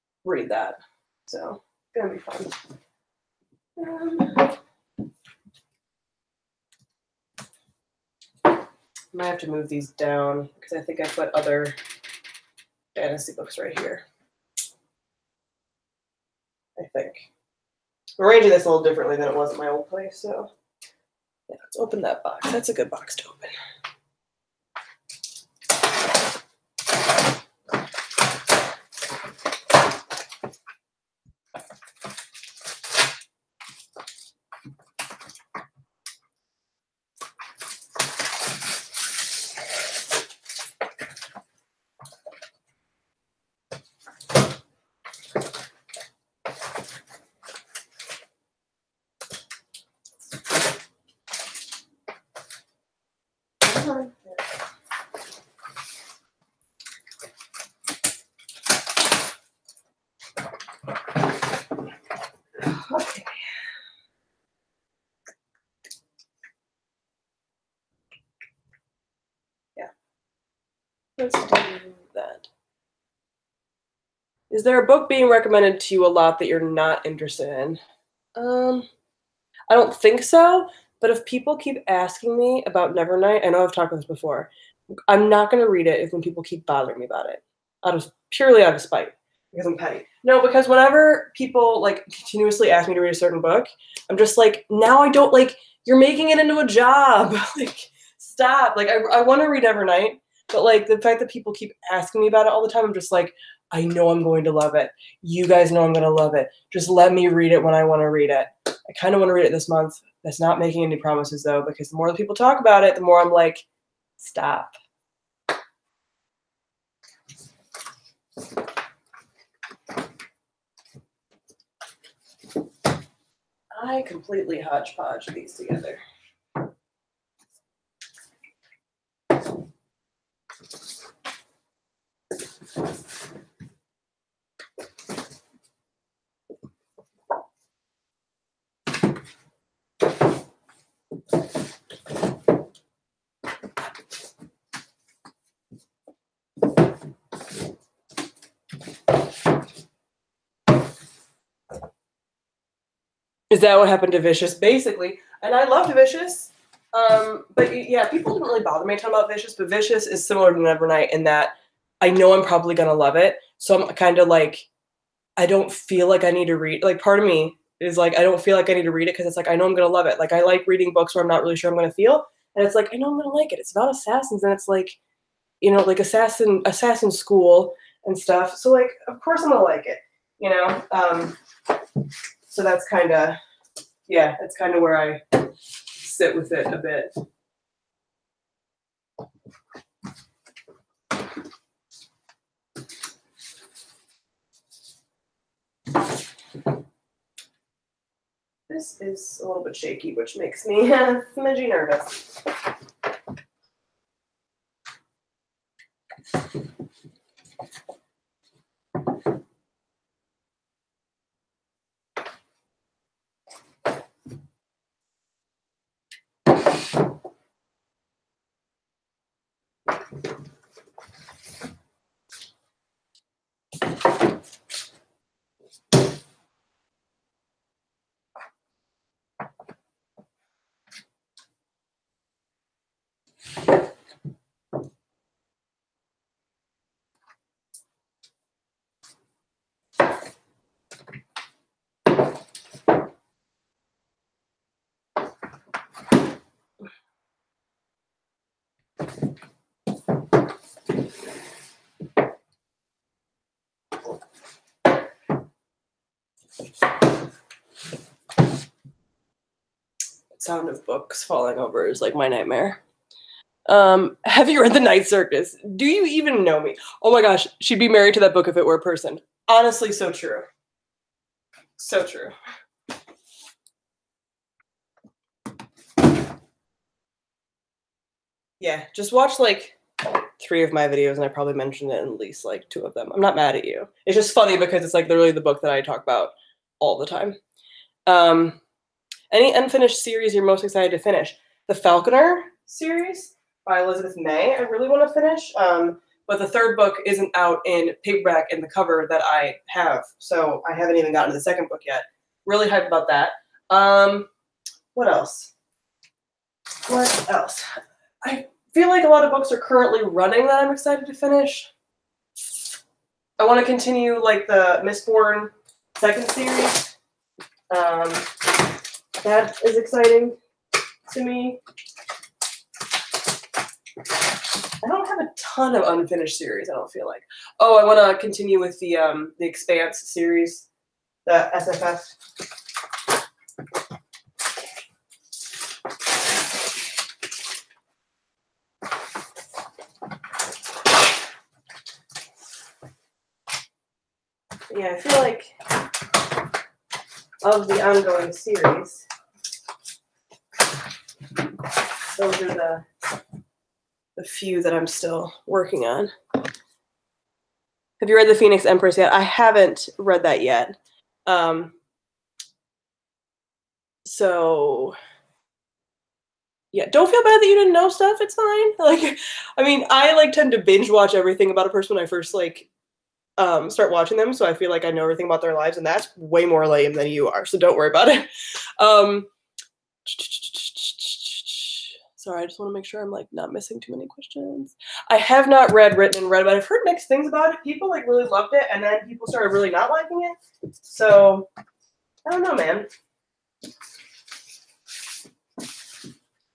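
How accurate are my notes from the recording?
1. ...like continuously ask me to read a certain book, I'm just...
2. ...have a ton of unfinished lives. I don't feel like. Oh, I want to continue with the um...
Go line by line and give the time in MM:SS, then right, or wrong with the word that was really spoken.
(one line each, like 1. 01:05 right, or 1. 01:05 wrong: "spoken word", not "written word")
1. 01:31 right
2. 05:25 wrong: "series", not "lives".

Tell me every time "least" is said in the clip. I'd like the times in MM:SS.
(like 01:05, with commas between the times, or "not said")
04:42.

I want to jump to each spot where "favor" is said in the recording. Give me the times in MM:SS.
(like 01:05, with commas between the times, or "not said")
not said.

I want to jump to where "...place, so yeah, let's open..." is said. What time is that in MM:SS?
00:19.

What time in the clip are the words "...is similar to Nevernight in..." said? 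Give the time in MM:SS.
02:40.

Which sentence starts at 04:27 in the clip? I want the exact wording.
Oh my gosh, she'd be married to that book if it were a person.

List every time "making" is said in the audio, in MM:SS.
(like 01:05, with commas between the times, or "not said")
01:35, 01:50.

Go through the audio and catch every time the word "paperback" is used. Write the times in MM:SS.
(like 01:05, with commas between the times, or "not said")
04:58.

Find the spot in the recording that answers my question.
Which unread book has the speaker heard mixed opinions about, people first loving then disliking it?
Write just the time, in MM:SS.
06:25.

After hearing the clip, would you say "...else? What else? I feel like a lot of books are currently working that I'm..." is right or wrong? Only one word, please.
wrong.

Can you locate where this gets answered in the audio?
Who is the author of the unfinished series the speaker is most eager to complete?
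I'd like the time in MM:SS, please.
04:53.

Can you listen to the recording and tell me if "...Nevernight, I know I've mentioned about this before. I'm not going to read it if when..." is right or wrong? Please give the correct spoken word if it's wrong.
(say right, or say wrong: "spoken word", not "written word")
wrong: "talked", not "mentioned".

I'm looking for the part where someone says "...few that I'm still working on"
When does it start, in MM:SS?
05:54.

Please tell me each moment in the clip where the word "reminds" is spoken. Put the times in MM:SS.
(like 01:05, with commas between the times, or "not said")
not said.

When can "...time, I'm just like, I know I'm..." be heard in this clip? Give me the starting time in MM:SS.
01:42.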